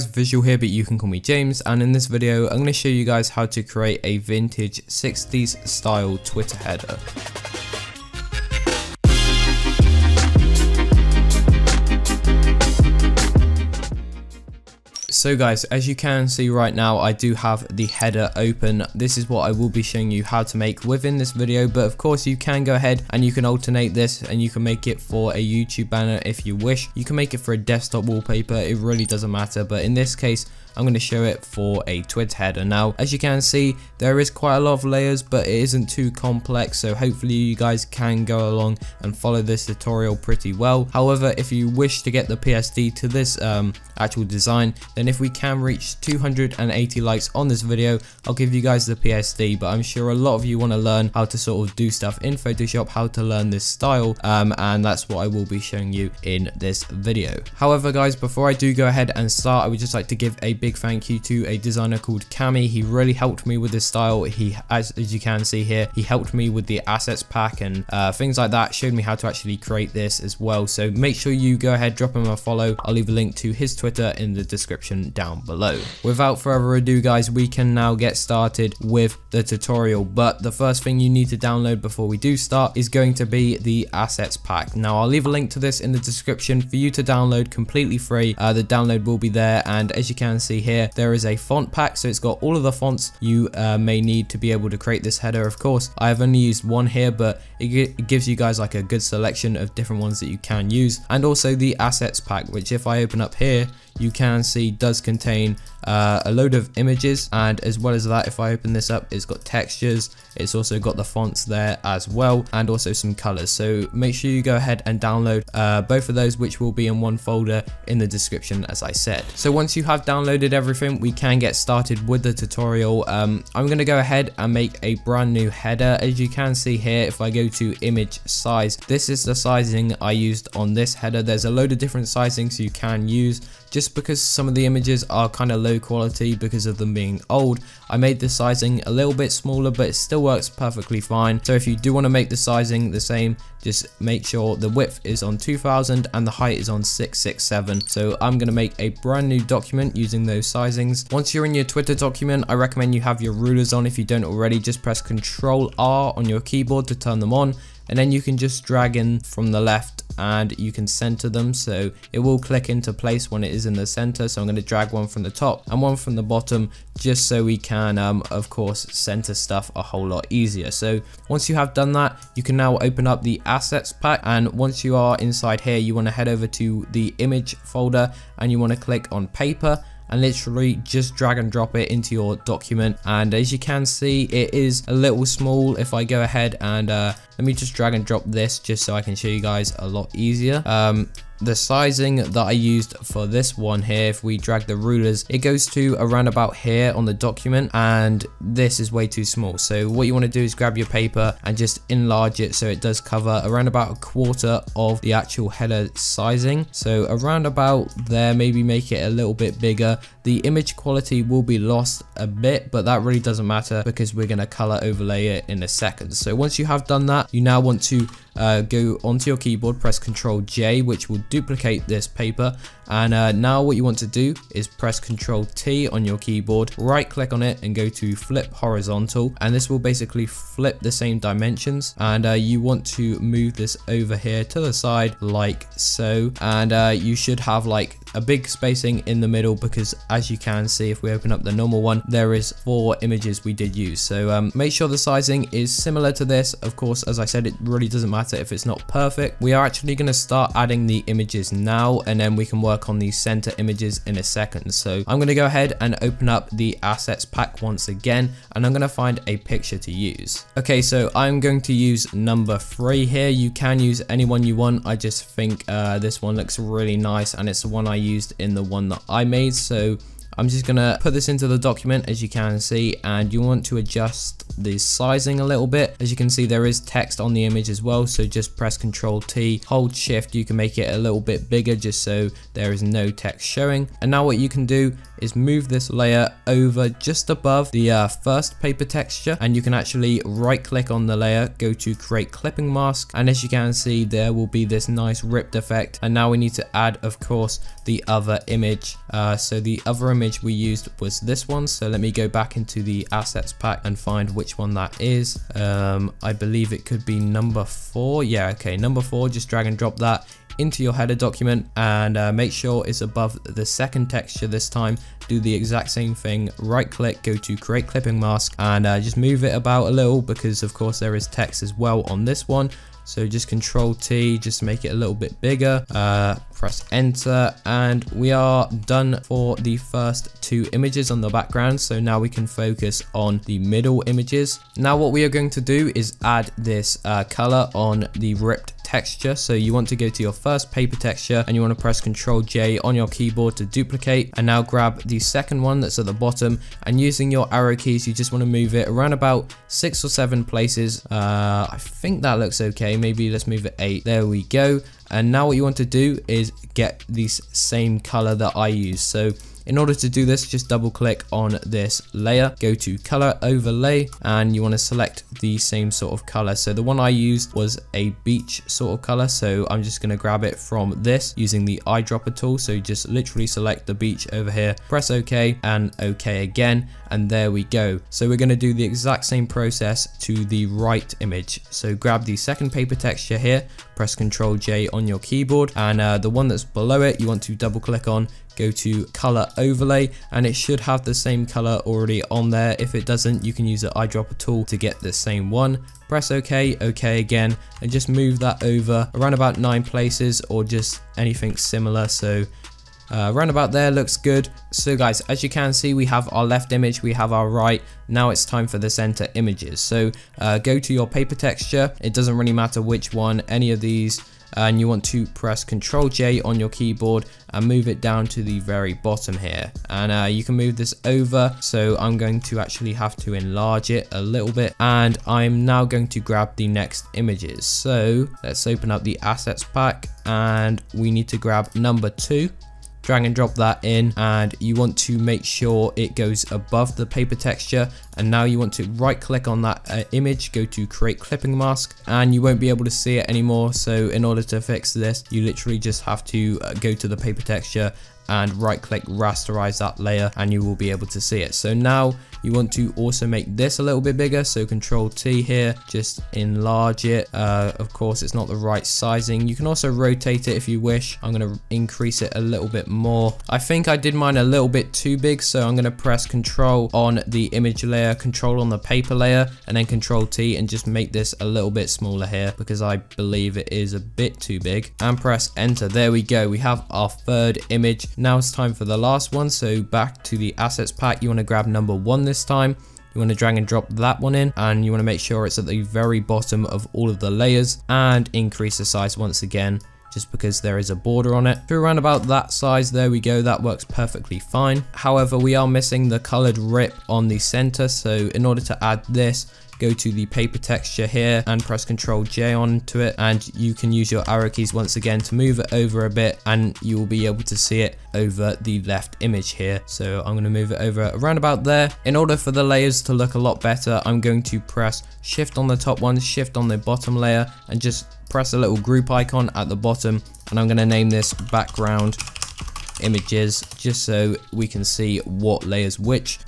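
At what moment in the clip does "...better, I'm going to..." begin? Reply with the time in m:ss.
8:33.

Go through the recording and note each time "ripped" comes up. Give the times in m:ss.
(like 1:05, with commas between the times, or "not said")
4:55, 5:38.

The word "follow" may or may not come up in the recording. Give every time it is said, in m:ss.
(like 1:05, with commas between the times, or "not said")
0:39, 1:12.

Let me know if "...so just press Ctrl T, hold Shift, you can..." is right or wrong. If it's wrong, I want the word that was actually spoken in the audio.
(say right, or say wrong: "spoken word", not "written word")
right.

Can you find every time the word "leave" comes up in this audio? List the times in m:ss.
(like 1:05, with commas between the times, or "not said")
1:12, 1:25.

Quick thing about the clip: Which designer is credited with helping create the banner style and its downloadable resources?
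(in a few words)
Kami.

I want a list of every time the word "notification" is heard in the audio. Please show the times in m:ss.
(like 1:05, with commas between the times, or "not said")
not said.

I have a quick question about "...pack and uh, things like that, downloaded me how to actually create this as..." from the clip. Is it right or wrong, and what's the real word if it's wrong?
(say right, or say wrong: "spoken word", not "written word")
wrong: "showed", not "downloaded".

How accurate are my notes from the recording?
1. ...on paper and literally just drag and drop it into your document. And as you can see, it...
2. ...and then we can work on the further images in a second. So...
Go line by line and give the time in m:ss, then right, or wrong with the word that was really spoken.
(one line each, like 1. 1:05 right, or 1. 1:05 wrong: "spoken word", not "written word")
1. 2:59 right
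2. 4:12 wrong: "center", not "further".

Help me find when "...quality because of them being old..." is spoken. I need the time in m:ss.
2:15.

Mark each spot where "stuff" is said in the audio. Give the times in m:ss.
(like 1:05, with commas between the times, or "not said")
0:51, 2:49.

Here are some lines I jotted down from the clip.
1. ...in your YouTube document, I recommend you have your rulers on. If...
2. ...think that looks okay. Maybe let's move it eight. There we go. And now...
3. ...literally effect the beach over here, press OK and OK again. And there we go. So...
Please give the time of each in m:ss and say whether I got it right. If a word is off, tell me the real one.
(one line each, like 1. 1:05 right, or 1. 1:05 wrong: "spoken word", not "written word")
1. 2:31 wrong: "Twitter", not "YouTube"
2. 5:51 right
3. 6:13 wrong: "select", not "effect".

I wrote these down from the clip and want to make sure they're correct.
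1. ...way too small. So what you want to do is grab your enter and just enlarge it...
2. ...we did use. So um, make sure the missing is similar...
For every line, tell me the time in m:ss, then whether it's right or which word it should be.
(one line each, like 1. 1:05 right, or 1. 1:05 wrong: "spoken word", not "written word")
1. 3:18 wrong: "paper", not "enter"
2. 4:03 wrong: "sizing", not "missing".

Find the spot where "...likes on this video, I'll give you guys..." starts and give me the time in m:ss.
0:47.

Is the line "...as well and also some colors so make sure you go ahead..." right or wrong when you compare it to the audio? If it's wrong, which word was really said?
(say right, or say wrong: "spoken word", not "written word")
right.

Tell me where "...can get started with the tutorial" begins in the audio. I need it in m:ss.
2:01.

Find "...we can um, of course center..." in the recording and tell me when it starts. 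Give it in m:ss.
2:47.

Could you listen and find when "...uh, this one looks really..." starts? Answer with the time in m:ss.
4:25.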